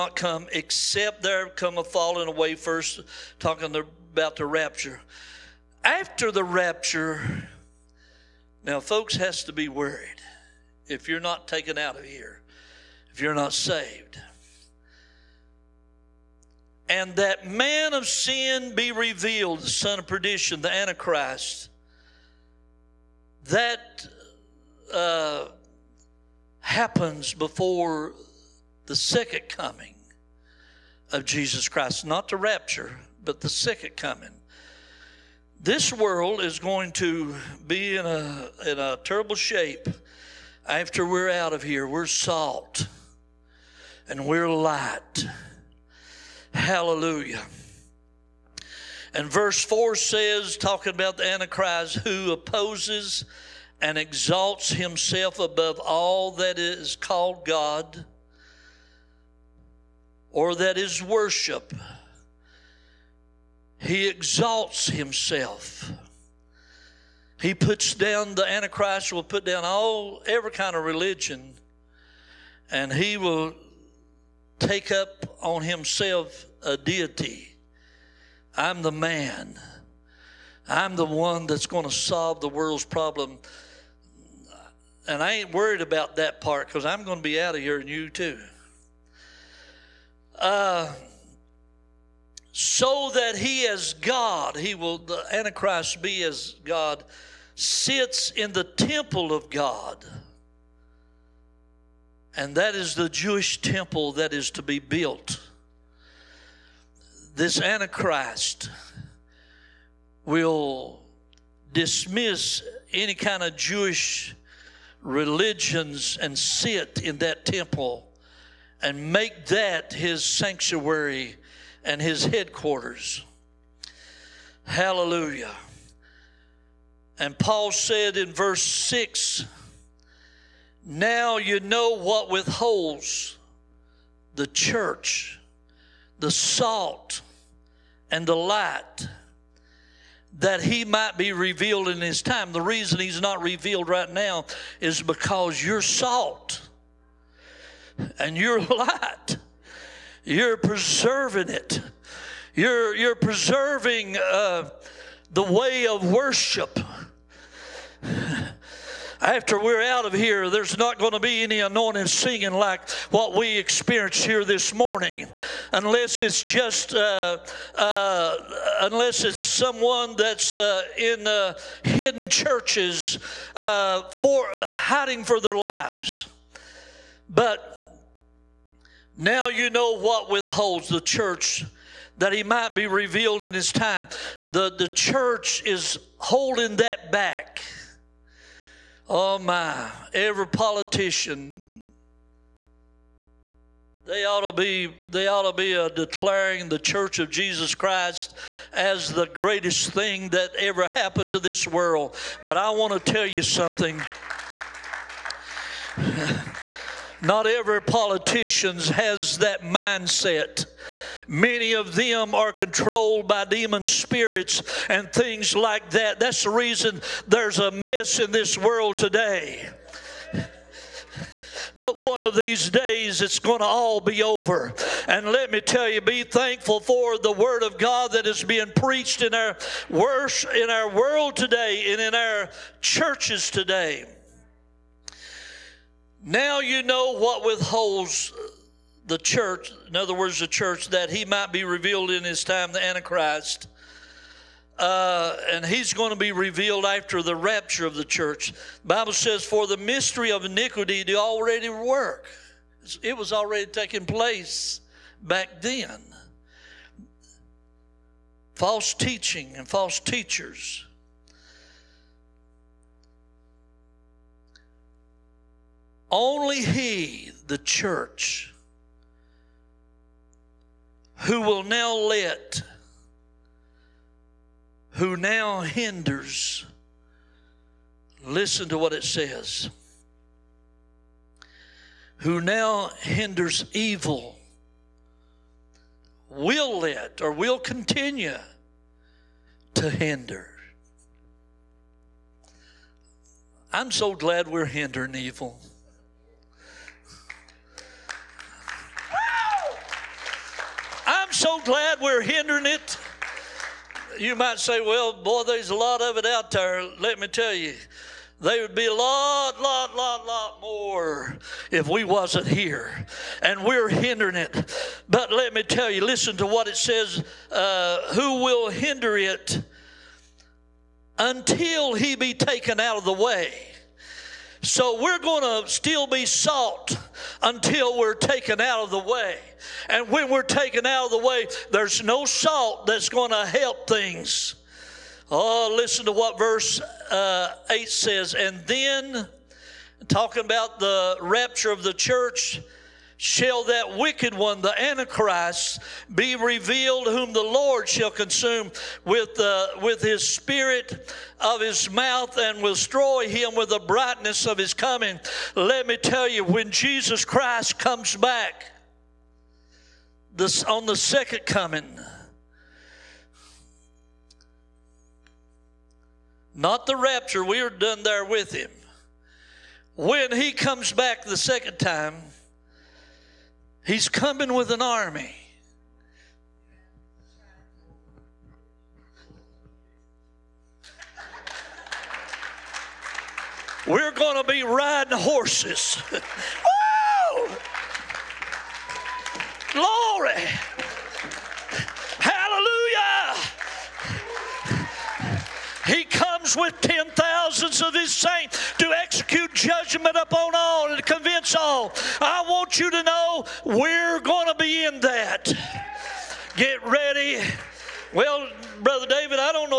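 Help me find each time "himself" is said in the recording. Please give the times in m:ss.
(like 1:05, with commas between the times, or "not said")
0:54, 1:04, 1:15.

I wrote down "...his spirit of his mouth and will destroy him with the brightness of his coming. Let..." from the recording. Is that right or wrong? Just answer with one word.
right.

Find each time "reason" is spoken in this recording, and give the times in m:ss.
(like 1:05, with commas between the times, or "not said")
2:22, 3:36.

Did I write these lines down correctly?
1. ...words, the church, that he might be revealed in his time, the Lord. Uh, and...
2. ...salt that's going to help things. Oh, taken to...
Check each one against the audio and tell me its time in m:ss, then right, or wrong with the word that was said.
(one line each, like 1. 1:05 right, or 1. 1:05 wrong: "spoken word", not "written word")
1. 4:00 wrong: "Antichrist", not "Lord"
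2. 5:32 wrong: "listen", not "taken".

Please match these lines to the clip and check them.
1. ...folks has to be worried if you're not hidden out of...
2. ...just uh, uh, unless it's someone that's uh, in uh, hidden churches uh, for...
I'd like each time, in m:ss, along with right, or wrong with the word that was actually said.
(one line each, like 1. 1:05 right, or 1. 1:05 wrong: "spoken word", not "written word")
1. 0:08 wrong: "taken", not "hidden"
2. 2:46 right.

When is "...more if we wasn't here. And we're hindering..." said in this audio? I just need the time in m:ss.
5:10.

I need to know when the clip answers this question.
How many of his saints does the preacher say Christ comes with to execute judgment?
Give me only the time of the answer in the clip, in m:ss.
6:36.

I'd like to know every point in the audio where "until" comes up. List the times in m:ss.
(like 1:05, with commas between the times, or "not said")
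5:21, 5:27.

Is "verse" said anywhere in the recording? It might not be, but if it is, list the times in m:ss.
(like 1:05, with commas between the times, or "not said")
0:49, 2:08, 5:36.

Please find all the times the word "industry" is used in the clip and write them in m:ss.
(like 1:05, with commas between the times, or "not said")
not said.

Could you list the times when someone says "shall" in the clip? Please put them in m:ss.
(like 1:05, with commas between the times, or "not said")
5:43, 5:47.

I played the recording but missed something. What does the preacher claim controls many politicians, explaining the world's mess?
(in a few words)
demon spirits.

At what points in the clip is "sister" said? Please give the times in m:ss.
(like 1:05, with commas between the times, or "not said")
not said.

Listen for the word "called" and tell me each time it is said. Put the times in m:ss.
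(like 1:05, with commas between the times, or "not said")
0:56.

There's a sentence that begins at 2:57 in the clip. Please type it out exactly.
But now you know what withholds the church that he might be revealed in his time.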